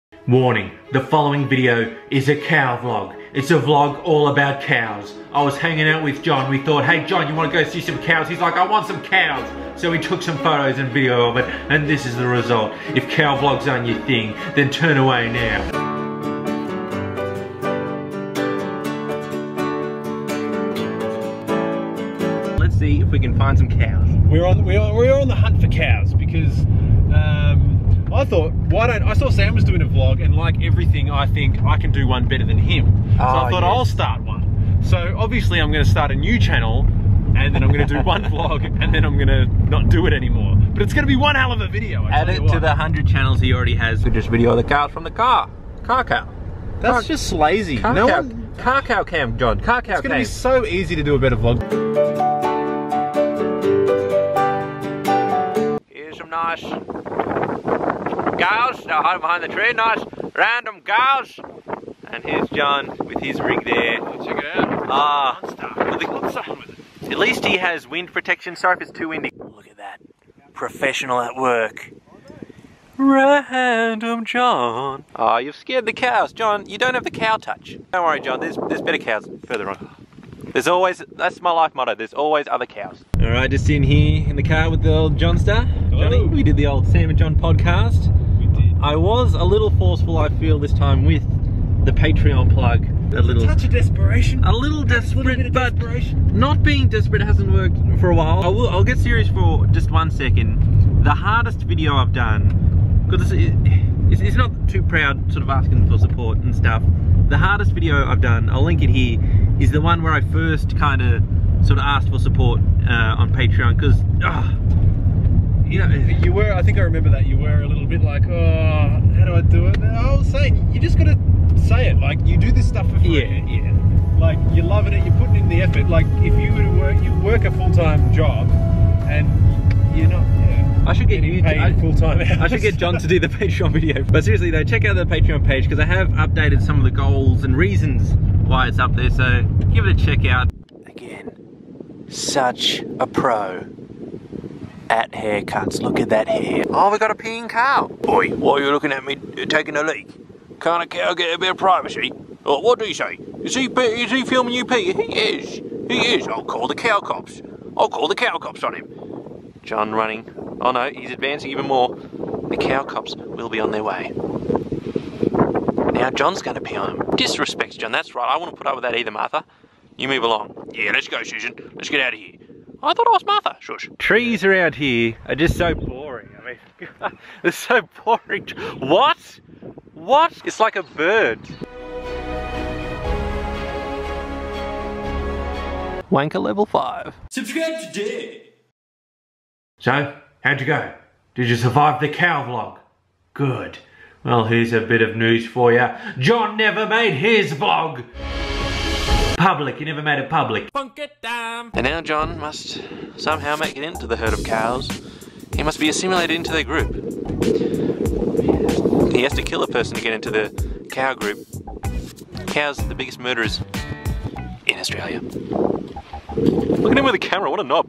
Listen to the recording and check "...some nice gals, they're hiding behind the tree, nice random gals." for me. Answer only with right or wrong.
right.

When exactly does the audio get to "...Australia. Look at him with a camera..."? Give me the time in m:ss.
3:34.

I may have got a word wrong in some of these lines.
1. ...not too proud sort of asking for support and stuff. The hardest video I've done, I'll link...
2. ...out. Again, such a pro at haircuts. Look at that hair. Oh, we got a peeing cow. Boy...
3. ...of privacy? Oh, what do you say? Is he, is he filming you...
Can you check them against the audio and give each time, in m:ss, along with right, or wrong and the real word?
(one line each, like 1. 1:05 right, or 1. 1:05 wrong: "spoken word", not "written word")
1. 1:44 right
2. 2:20 right
3. 2:31 right.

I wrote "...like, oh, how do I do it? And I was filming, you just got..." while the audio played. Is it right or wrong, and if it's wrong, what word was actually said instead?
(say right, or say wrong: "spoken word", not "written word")
wrong: "saying", not "filming".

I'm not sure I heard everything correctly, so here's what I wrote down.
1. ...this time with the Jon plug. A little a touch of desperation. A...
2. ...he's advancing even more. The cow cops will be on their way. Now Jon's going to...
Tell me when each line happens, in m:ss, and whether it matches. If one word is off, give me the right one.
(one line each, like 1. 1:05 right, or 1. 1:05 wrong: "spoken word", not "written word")
1. 1:30 wrong: "Patreon", not "Jon"
2. 2:40 right.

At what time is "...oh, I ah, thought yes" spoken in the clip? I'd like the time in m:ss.
0:33.